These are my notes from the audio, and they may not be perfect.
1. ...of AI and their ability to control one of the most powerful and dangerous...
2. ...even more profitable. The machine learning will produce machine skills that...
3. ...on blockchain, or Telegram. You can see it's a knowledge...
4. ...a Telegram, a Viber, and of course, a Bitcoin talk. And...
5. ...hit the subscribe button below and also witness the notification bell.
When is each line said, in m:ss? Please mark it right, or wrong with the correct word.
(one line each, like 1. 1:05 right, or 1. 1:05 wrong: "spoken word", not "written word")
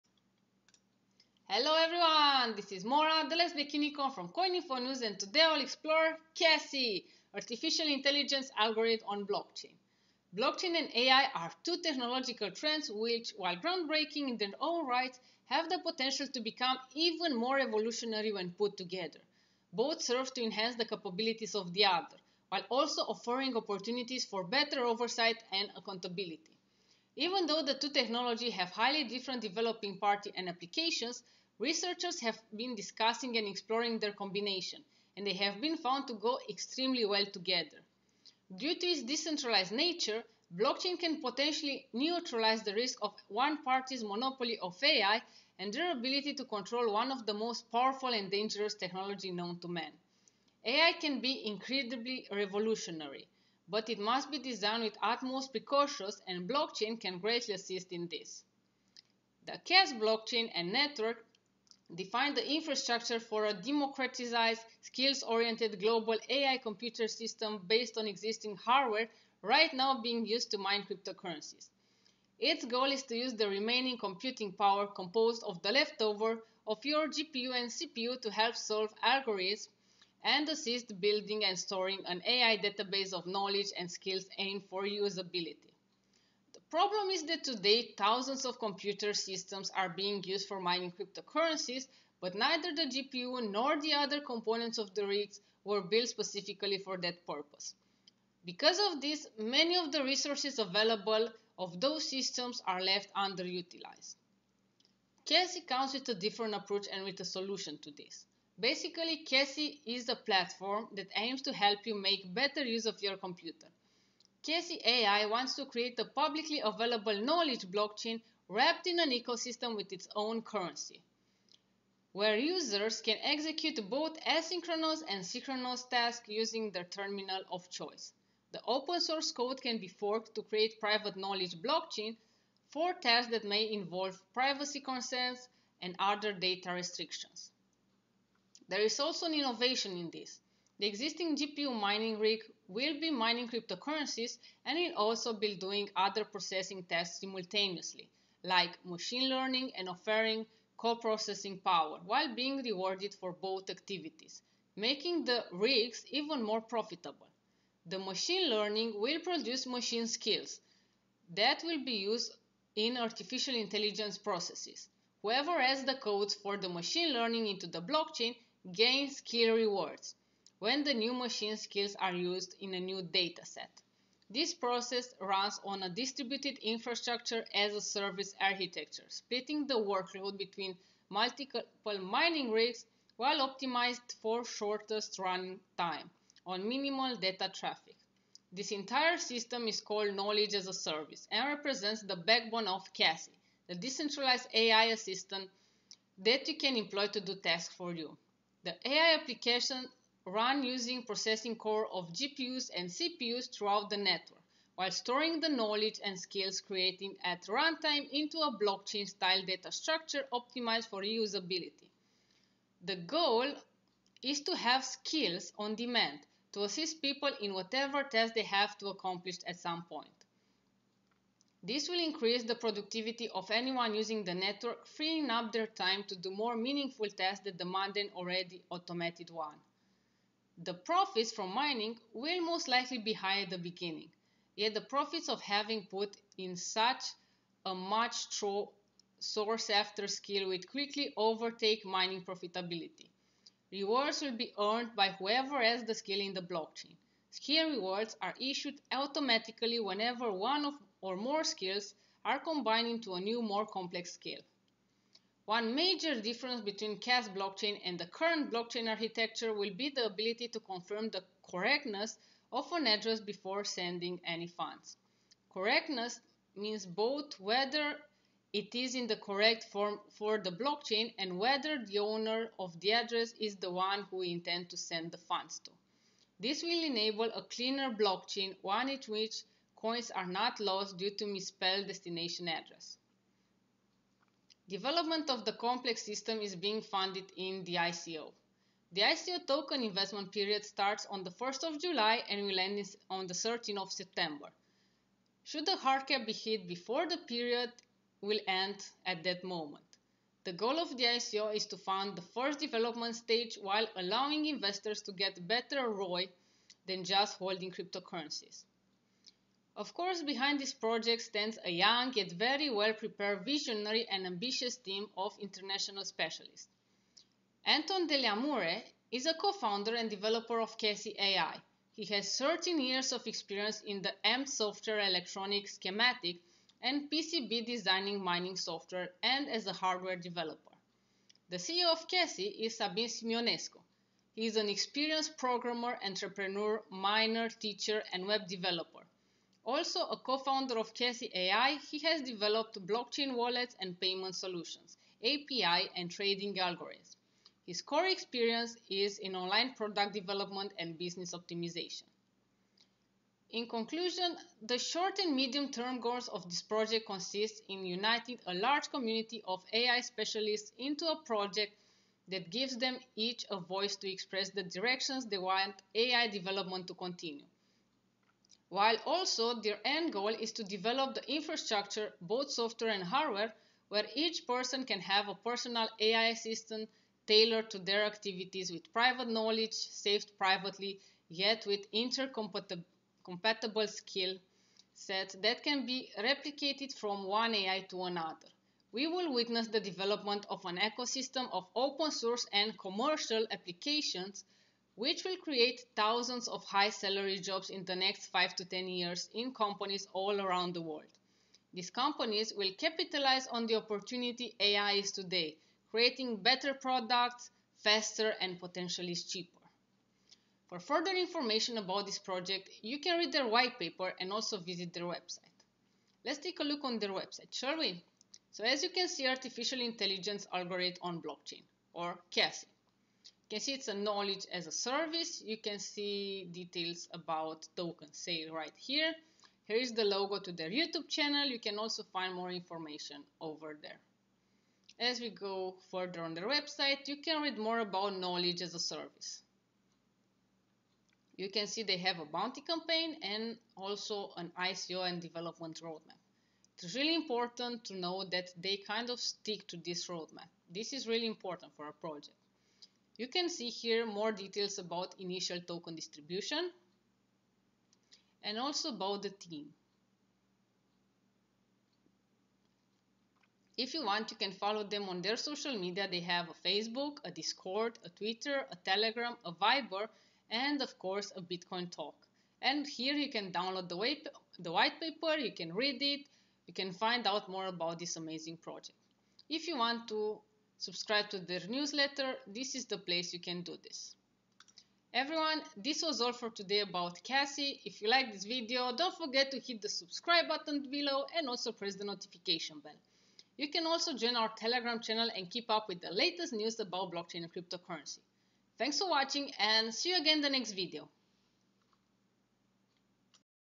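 1. 0:44 right
2. 2:36 right
3. 7:01 wrong: "Kaasy", not "Telegram"
4. 7:48 right
5. 8:09 wrong: "press", not "witness".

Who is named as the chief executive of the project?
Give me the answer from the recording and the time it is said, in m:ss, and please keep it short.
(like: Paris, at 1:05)
Sabin Simionescu, at 5:32.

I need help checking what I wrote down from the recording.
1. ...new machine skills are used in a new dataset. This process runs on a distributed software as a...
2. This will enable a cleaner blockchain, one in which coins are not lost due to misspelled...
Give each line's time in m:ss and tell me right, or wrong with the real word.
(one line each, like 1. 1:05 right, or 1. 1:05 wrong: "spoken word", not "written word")
1. 2:50 wrong: "infrastructure", not "software"
2. 4:36 right.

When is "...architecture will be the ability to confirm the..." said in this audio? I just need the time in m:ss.
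4:18.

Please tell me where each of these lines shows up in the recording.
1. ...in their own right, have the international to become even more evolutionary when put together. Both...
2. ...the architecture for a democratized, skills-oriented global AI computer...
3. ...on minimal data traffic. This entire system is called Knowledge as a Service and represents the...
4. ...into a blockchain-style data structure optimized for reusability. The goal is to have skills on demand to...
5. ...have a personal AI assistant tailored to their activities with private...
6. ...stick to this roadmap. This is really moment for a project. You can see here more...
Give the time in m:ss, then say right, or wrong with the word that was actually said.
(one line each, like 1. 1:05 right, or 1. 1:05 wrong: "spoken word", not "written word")
1. 0:14 wrong: "potential", not "international"
2. 1:02 wrong: "infrastructure", not "architecture"
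3. 3:06 right
4. 3:28 right
5. 6:15 right
6. 7:29 wrong: "important", not "moment".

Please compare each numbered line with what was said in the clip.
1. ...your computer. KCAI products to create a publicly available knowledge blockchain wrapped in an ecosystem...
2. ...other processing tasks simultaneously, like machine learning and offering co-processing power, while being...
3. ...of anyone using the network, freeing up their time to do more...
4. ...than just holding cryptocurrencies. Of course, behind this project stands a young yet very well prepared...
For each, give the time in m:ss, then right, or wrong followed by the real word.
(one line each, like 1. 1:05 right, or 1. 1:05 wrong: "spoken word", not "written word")
1. 1:53 wrong: "wants", not "products"
2. 2:25 right
3. 3:43 right
4. 5:06 right.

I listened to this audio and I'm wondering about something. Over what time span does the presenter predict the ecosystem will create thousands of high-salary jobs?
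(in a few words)
5 to 10 years.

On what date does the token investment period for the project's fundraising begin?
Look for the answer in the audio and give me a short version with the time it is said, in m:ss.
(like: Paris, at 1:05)
July 1, at 4:51.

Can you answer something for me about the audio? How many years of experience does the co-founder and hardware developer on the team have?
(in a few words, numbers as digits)
13.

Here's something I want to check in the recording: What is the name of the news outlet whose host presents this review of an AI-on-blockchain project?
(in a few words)
CoinInfo News.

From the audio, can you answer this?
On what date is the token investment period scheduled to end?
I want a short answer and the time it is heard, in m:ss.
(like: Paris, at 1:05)
September 13, at 4:53.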